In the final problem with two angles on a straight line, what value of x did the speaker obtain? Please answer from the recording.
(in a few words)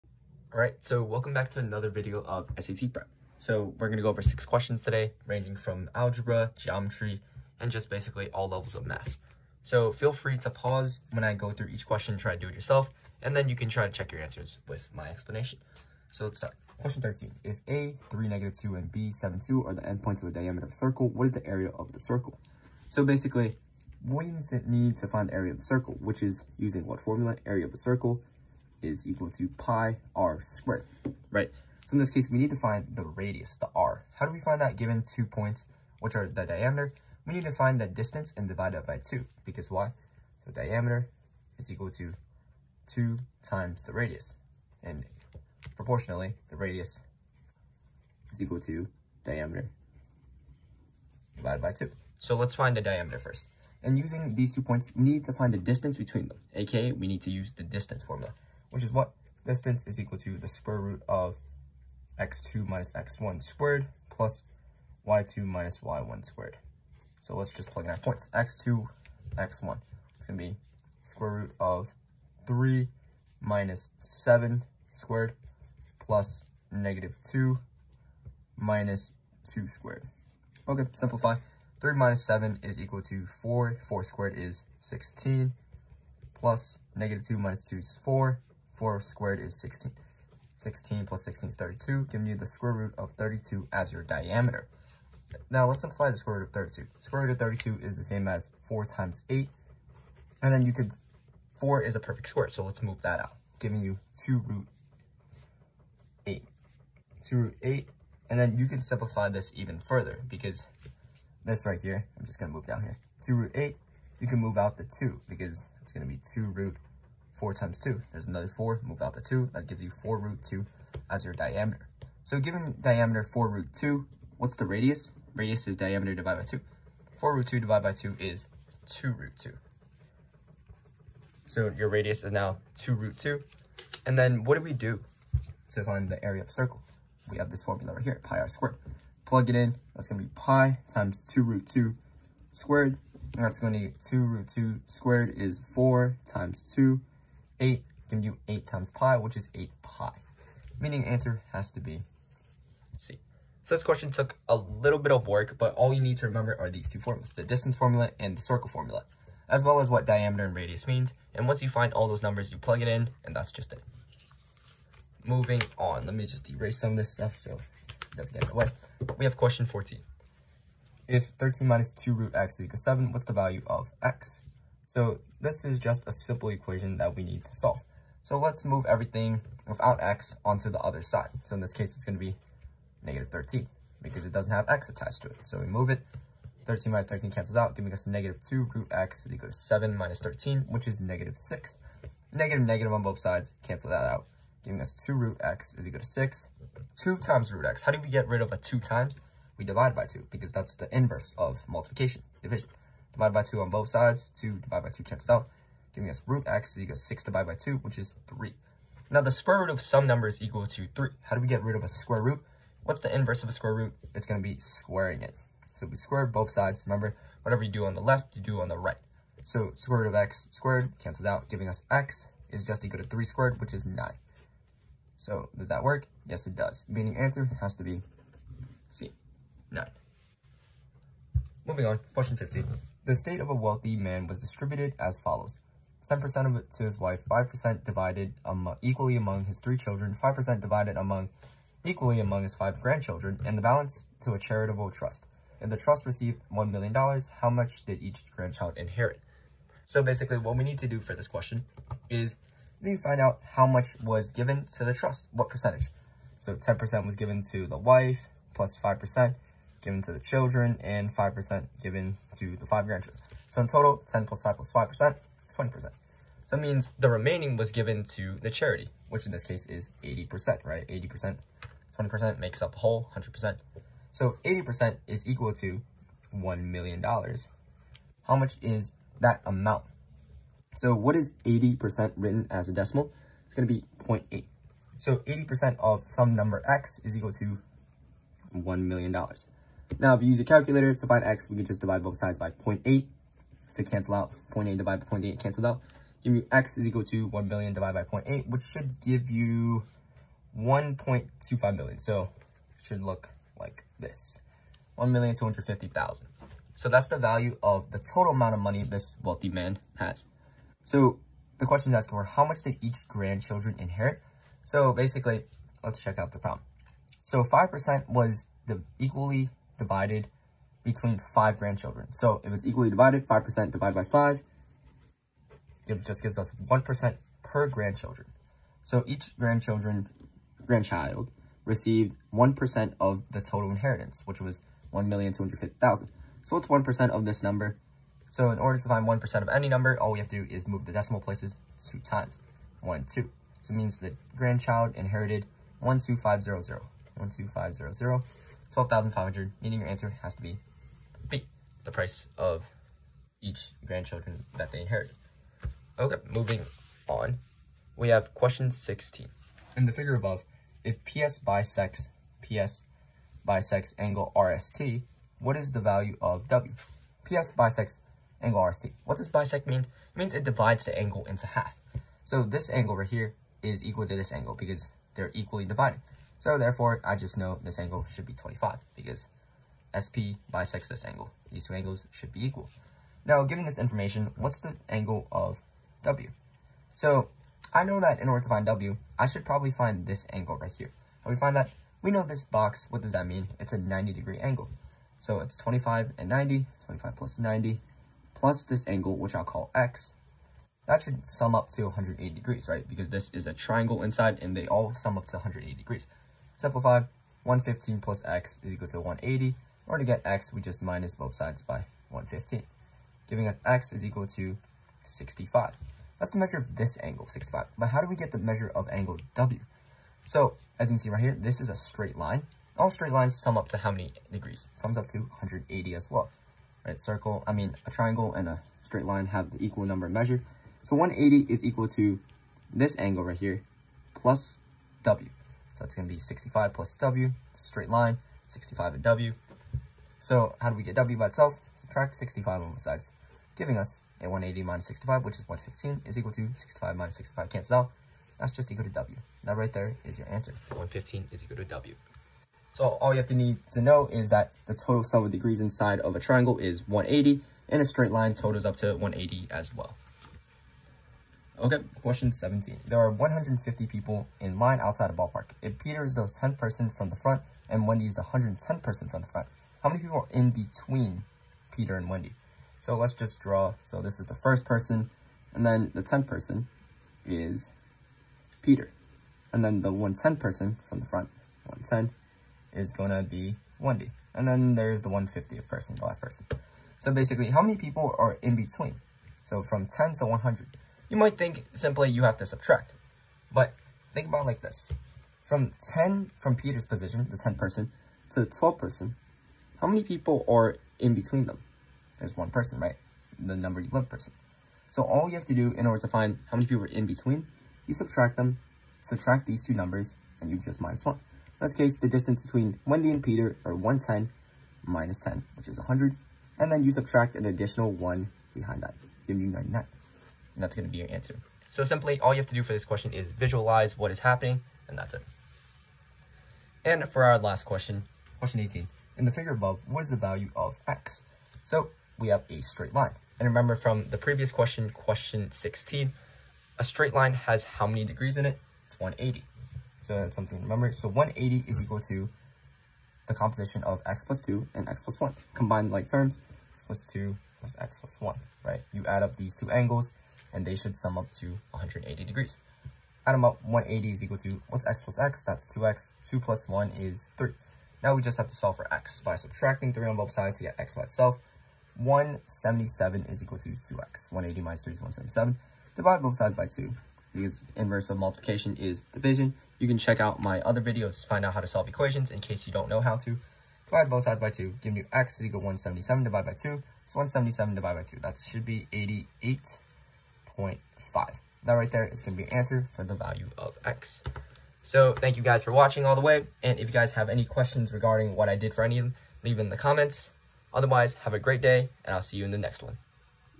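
88.5.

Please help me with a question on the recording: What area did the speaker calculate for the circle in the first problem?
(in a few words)
8 pi.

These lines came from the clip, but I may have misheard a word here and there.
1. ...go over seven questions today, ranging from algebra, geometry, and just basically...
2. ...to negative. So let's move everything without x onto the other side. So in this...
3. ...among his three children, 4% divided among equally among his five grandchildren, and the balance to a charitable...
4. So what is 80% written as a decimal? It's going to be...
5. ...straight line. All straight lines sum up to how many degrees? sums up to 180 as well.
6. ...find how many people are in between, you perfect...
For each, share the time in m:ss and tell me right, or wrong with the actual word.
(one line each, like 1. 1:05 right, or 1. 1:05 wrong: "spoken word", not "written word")
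1. 0:04 wrong: "six", not "seven"
2. 2:57 wrong: "solve", not "negative"
3. 3:59 wrong: "5", not "4"
4. 4:40 right
5. 7:01 right
6. 8:26 wrong: "subtract", not "perfect".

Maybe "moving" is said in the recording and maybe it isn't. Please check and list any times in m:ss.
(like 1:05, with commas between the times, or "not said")
2:45, 3:51, 5:56.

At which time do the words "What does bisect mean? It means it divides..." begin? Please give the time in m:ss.
6:09.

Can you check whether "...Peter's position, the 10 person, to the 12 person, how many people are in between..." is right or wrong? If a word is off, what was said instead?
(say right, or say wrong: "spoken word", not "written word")
right.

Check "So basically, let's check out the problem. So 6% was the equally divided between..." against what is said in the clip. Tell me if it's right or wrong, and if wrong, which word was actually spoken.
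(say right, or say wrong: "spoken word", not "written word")
wrong: "5", not "6".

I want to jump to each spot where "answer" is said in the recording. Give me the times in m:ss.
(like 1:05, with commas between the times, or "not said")
0:14, 2:31, 3:47, 5:49, 7:30, 8:41, 9:42.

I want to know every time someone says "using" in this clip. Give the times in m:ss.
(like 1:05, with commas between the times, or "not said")
0:26, 0:53.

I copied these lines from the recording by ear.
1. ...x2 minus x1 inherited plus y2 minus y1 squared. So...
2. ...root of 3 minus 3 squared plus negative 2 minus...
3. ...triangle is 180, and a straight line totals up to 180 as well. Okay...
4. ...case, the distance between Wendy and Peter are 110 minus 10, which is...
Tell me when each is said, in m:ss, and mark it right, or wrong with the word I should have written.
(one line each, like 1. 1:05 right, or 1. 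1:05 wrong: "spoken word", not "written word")
1. 1:02 wrong: "squared", not "inherited"
2. 1:11 wrong: "7", not "3"
3. 7:36 right
4. 8:31 right.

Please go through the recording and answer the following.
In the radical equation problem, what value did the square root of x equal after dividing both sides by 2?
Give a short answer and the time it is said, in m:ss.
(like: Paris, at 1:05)
3, at 3:26.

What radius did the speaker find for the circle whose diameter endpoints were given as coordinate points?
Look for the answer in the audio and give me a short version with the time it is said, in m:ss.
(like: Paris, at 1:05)
2 root 2, at 2:11.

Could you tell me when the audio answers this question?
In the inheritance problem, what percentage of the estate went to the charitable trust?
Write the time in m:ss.
4:29.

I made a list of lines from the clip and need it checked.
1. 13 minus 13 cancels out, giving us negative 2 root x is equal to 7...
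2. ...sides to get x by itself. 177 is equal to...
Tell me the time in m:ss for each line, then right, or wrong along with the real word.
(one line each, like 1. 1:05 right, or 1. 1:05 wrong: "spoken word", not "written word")
1. 3:06 right
2. 9:20 right.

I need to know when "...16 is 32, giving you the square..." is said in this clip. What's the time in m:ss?
1:31.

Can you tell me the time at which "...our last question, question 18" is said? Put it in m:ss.
8:47.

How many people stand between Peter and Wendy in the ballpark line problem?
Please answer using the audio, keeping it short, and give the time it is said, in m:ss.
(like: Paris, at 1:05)
99, at 8:39.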